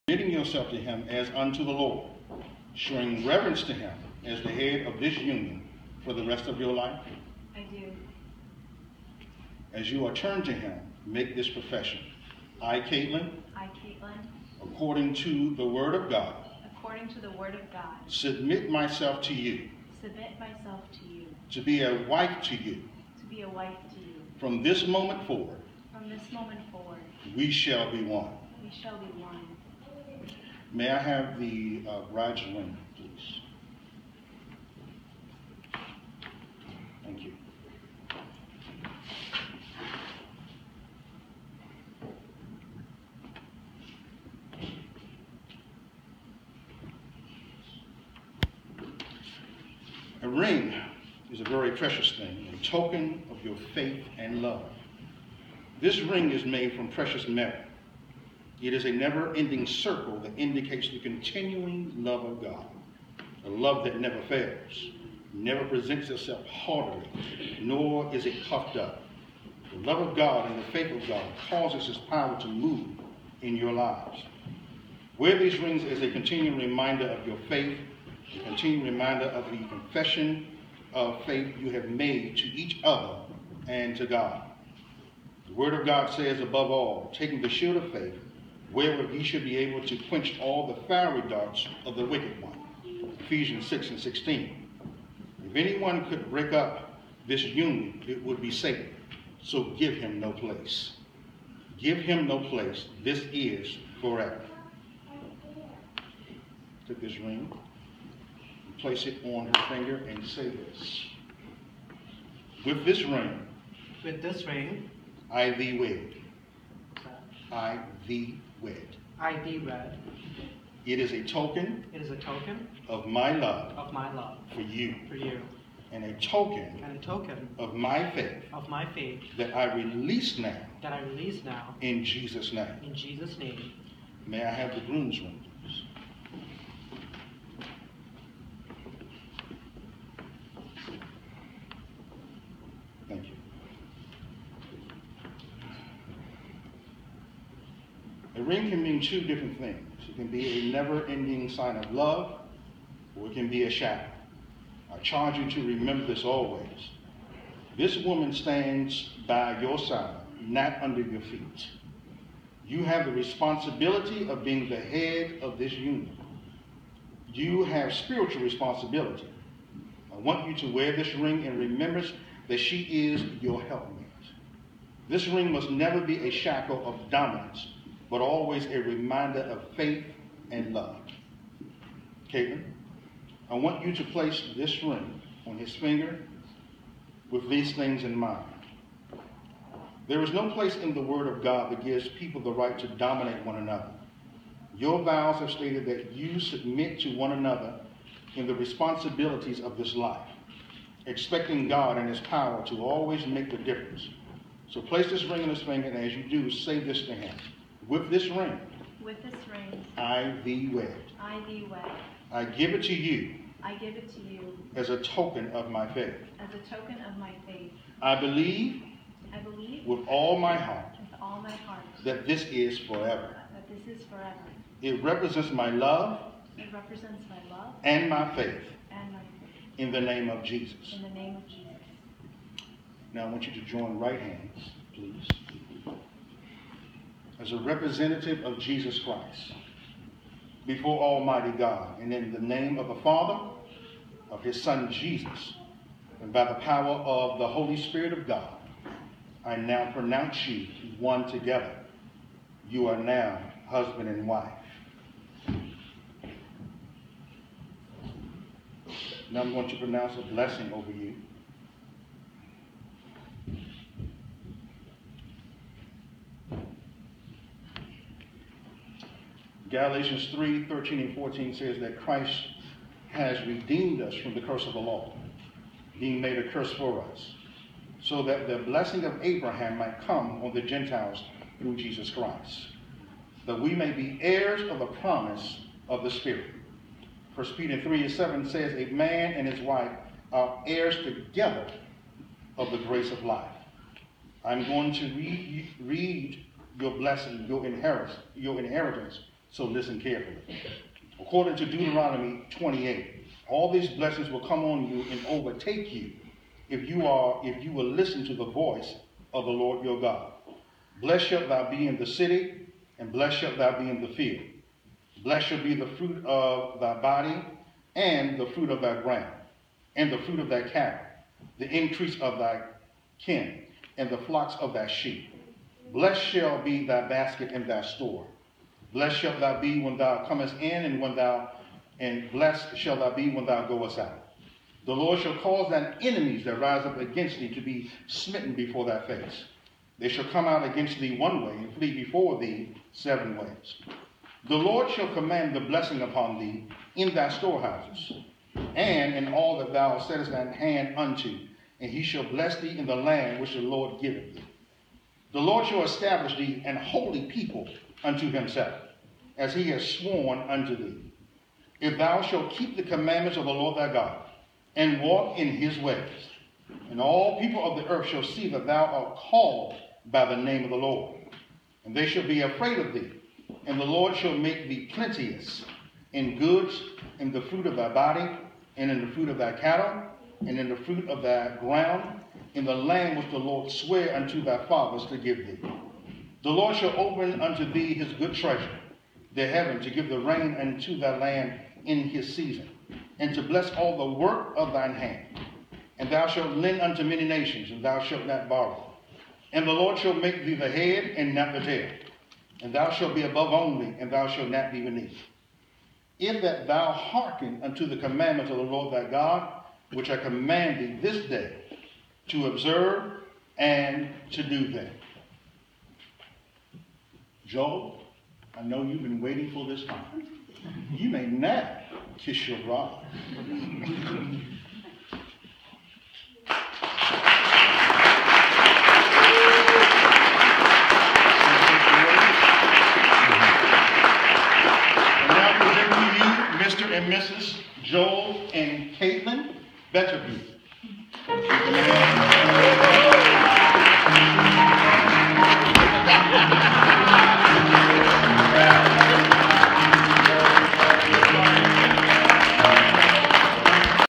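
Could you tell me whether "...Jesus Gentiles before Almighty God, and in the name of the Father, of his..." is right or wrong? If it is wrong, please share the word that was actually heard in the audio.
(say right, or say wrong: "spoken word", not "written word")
wrong: "Christ", not "Gentiles".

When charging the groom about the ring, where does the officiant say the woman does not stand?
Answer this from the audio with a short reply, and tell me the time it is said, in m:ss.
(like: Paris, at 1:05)
under your feet, at 2:40.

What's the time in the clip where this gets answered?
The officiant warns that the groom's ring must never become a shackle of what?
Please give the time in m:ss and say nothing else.
2:57.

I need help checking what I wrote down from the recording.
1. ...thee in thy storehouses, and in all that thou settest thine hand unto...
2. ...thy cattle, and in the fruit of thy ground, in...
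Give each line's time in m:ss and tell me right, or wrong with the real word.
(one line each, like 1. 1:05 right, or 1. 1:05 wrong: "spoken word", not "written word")
1. 5:46 right
2. 6:19 right.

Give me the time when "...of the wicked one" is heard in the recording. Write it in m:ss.
1:31.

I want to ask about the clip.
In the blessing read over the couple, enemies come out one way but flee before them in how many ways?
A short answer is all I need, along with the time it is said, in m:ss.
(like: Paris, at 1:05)
7, at 5:42.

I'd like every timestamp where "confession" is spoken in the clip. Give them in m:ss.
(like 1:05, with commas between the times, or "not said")
1:19.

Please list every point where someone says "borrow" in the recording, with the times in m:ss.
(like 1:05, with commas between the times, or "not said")
6:38.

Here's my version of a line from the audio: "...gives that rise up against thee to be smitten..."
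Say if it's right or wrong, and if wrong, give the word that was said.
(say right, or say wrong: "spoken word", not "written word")
wrong: "enemies", not "gives".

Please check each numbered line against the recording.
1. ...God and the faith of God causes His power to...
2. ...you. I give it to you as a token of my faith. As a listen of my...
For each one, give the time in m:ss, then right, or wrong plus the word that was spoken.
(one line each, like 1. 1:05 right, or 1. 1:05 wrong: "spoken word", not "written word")
1. 1:10 right
2. 3:32 wrong: "token", not "listen".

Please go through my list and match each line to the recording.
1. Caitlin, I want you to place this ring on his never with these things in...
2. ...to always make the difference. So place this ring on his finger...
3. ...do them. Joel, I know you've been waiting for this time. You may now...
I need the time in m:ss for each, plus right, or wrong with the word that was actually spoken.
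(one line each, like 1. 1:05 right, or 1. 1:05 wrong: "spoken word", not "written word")
1. 3:02 wrong: "finger", not "never"
2. 3:22 right
3. 6:54 right.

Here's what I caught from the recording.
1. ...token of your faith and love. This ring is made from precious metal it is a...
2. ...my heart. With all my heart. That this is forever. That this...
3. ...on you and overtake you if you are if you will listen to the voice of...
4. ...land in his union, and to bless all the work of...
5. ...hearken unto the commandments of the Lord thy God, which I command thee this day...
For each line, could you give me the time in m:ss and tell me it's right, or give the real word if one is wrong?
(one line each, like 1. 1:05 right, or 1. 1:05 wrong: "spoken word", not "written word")
1. 0:52 right
2. 3:40 right
3. 5:04 right
4. 6:31 wrong: "season", not "union"
5. 6:46 right.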